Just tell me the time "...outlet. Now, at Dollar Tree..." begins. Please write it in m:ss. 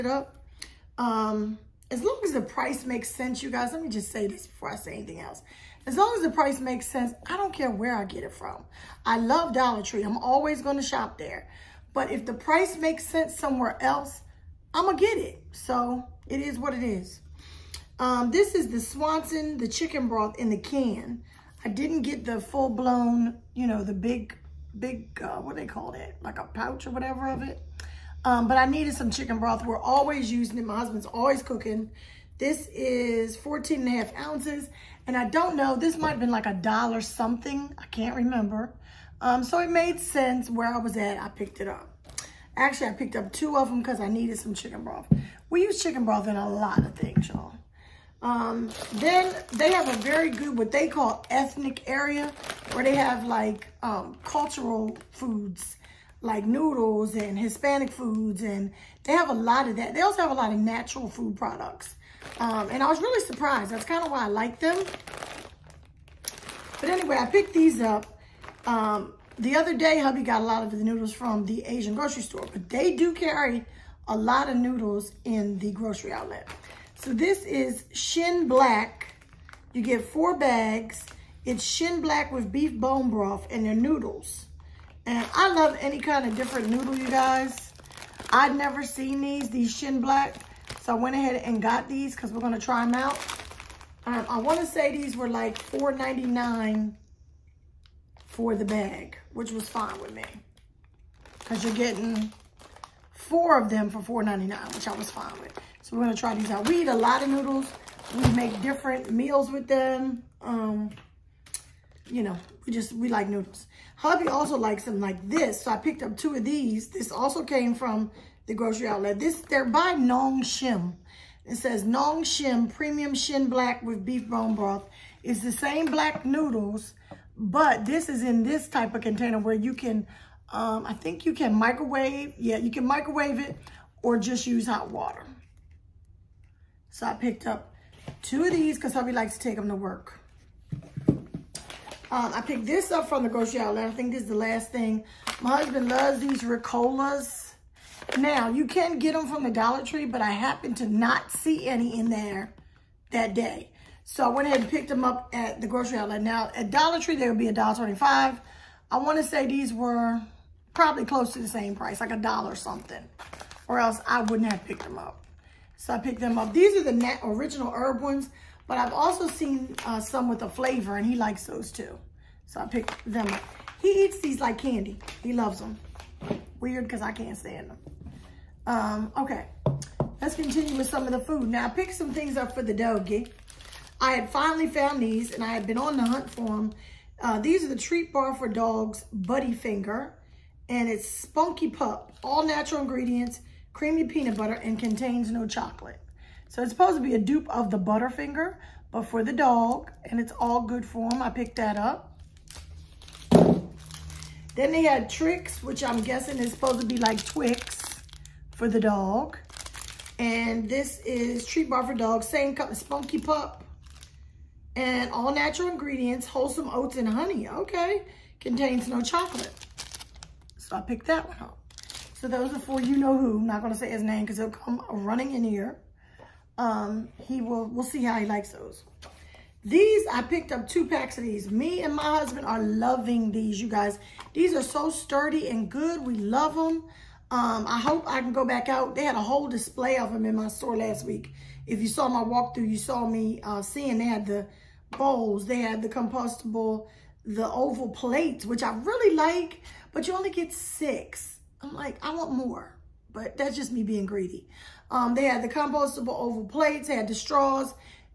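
2:35.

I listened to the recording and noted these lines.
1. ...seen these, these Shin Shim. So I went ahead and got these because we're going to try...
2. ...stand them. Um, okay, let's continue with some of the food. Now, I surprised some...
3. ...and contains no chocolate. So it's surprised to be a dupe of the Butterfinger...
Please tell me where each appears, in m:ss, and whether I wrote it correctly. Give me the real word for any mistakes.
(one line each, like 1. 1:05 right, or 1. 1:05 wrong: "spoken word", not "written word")
1. 1:28 wrong: "Black", not "Shim"
2. 2:57 wrong: "picked", not "surprised"
3. 3:14 wrong: "supposed", not "surprised".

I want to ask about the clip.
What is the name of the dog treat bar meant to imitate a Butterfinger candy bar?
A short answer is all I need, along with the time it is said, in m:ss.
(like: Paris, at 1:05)
Buddy Finger, at 3:09.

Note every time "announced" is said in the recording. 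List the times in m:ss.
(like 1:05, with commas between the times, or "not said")
not said.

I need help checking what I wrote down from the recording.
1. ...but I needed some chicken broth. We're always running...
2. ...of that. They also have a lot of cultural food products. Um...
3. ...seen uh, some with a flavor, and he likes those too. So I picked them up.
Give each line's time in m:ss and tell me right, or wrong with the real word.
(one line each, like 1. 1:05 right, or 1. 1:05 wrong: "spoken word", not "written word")
1. 0:28 wrong: "using", not "running"
2. 0:59 wrong: "natural", not "cultural"
3. 2:49 right.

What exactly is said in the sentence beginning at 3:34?
And all natural ingredients, wholesome oats and honey.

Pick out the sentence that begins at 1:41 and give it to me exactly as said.
Because you're getting four of them for $4.99, which I was fine with.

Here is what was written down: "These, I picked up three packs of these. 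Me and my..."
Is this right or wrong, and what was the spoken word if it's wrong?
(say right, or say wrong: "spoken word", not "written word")
wrong: "two", not "three".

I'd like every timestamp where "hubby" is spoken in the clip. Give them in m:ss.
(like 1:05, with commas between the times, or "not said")
1:09, 1:53, 2:18.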